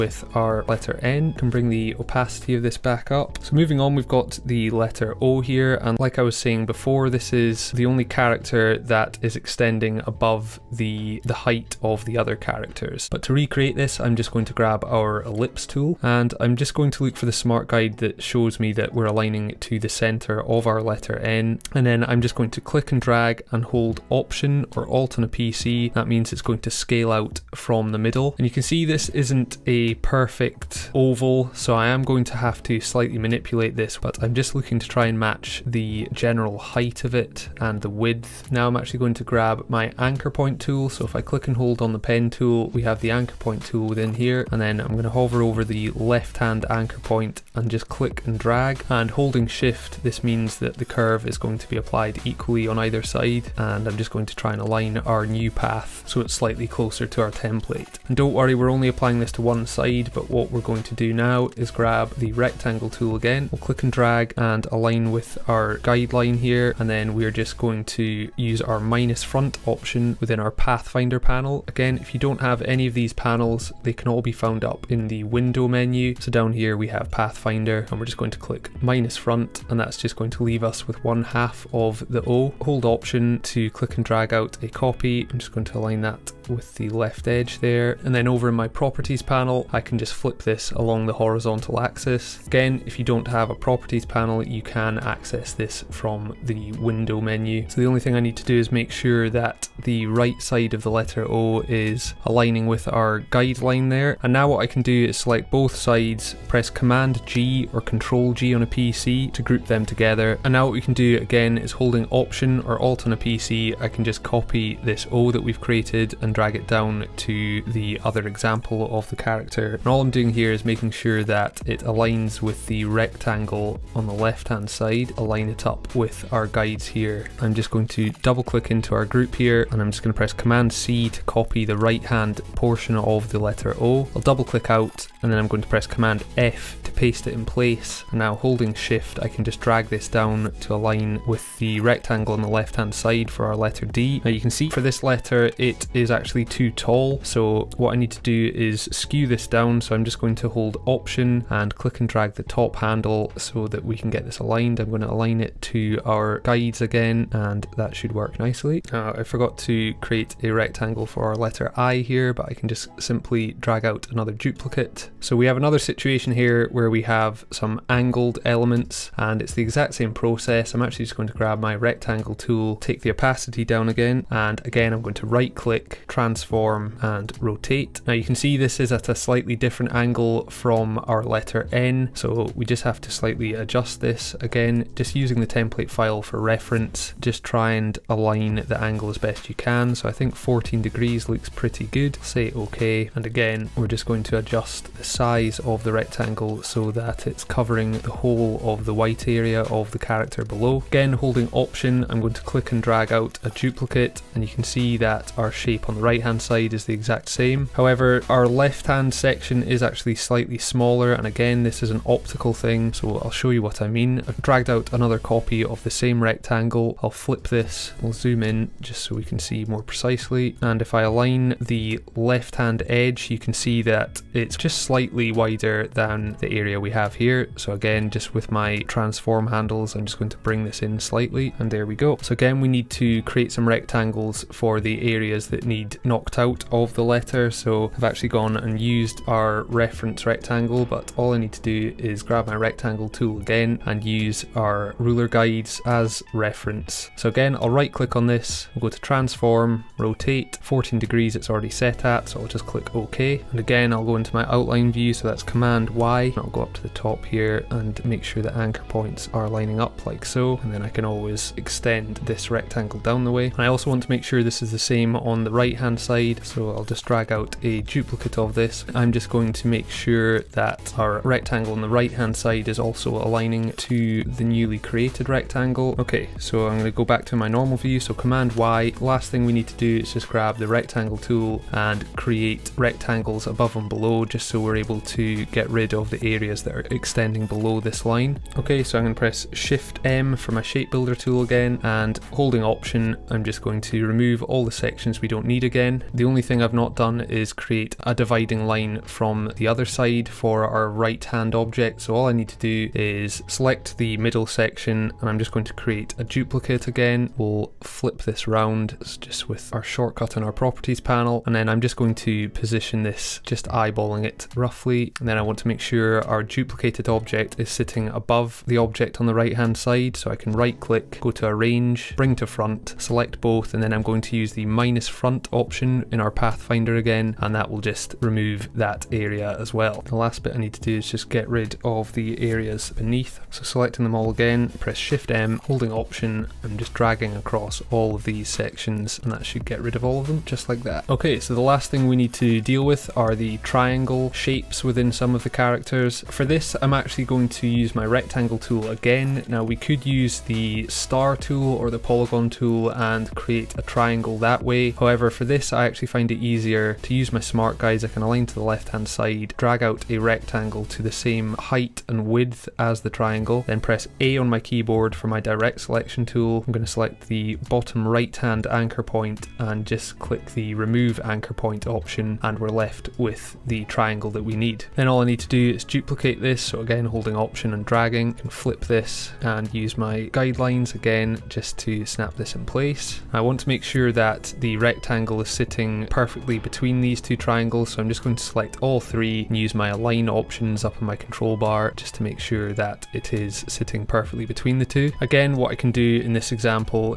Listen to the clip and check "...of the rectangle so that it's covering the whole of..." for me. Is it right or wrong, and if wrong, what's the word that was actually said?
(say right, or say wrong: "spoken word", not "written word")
right.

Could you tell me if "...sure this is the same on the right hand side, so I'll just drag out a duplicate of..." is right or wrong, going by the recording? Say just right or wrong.
right.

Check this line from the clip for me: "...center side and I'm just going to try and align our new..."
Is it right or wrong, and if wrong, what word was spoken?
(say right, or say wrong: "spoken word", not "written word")
wrong: "either", not "center".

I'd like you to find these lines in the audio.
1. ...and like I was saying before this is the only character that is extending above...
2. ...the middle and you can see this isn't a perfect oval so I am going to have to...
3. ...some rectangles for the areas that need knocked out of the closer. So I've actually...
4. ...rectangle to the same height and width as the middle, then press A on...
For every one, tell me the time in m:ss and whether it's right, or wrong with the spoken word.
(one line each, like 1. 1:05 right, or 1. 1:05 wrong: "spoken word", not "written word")
1. 0:05 right
2. 0:27 right
3. 3:53 wrong: "letter", not "closer"
4. 6:00 wrong: "triangle", not "middle".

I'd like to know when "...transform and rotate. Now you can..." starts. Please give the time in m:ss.
2:56.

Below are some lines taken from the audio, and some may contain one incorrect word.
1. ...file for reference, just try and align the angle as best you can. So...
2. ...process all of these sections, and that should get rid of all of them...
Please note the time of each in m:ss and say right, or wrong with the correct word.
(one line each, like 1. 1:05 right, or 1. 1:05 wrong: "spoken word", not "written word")
1. 3:05 right
2. 5:37 wrong: "across", not "process".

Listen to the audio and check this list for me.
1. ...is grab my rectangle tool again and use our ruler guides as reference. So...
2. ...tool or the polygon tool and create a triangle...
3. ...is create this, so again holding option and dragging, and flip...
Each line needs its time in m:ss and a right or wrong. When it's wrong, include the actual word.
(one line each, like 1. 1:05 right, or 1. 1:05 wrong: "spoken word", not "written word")
1. 4:01 right
2. 5:51 right
3. 6:15 wrong: "duplicate", not "create".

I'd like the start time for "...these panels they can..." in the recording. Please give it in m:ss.
1:12.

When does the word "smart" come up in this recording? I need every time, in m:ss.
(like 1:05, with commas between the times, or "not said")
0:17, 5:57.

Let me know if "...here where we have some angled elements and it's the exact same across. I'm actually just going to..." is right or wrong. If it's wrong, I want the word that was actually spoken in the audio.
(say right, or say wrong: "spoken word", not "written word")
wrong: "process", not "across".